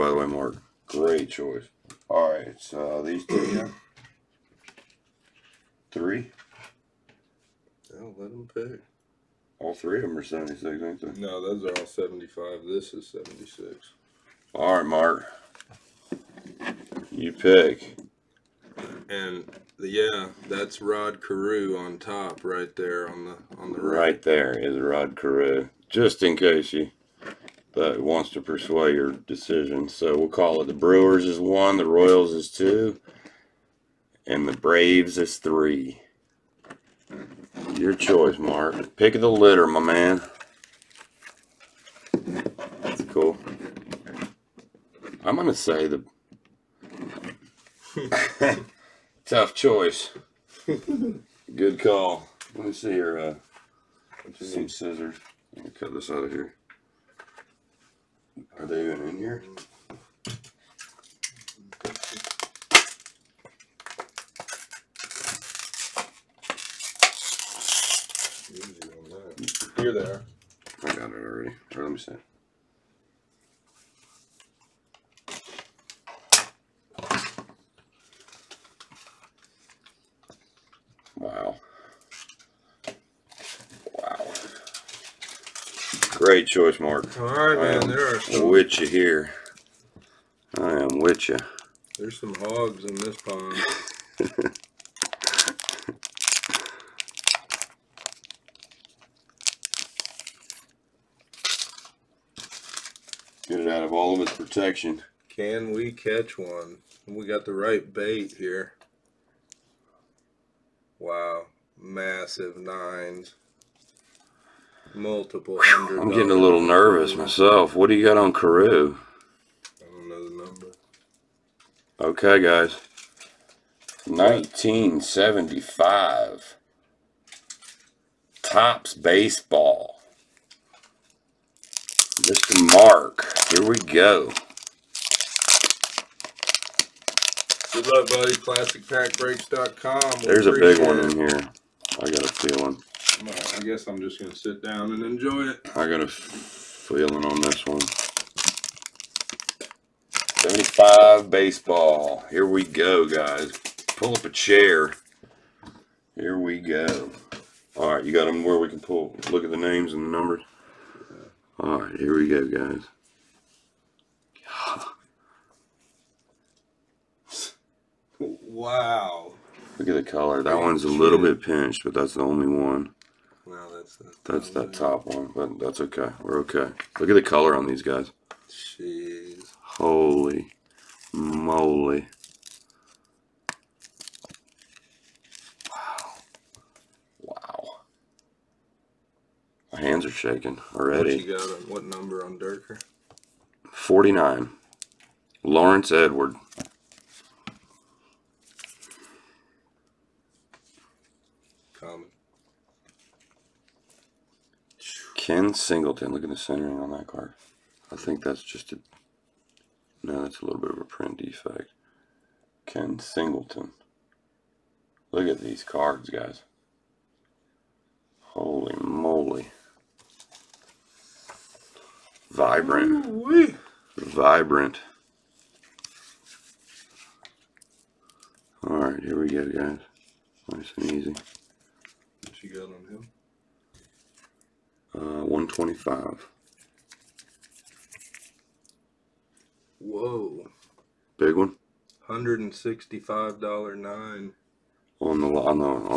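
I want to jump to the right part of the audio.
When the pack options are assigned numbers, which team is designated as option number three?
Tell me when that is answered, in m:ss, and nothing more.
0:34.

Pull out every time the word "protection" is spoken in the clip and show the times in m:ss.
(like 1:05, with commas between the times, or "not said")
1:44.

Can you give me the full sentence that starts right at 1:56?
I'm getting a little nervous myself.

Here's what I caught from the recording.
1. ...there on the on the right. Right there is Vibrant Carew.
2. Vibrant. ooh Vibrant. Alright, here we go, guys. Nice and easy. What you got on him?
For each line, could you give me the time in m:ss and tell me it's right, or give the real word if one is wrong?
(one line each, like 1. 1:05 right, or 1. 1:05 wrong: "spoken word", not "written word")
1. 0:22 wrong: "Rod", not "Vibrant"
2. 3:42 right.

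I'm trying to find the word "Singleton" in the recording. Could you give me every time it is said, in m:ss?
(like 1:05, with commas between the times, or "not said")
3:25, 3:32.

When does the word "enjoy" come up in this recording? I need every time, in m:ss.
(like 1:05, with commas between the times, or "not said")
2:25.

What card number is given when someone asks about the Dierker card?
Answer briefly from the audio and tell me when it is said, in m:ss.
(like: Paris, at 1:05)
49, at 3:13.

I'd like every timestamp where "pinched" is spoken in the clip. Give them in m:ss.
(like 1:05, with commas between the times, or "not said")
2:51.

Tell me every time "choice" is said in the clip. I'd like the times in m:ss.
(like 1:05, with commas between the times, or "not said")
0:01, 0:37, 0:49, 1:26.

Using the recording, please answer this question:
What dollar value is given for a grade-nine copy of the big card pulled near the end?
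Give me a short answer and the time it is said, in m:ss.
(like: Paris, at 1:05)
$165, at 4:02.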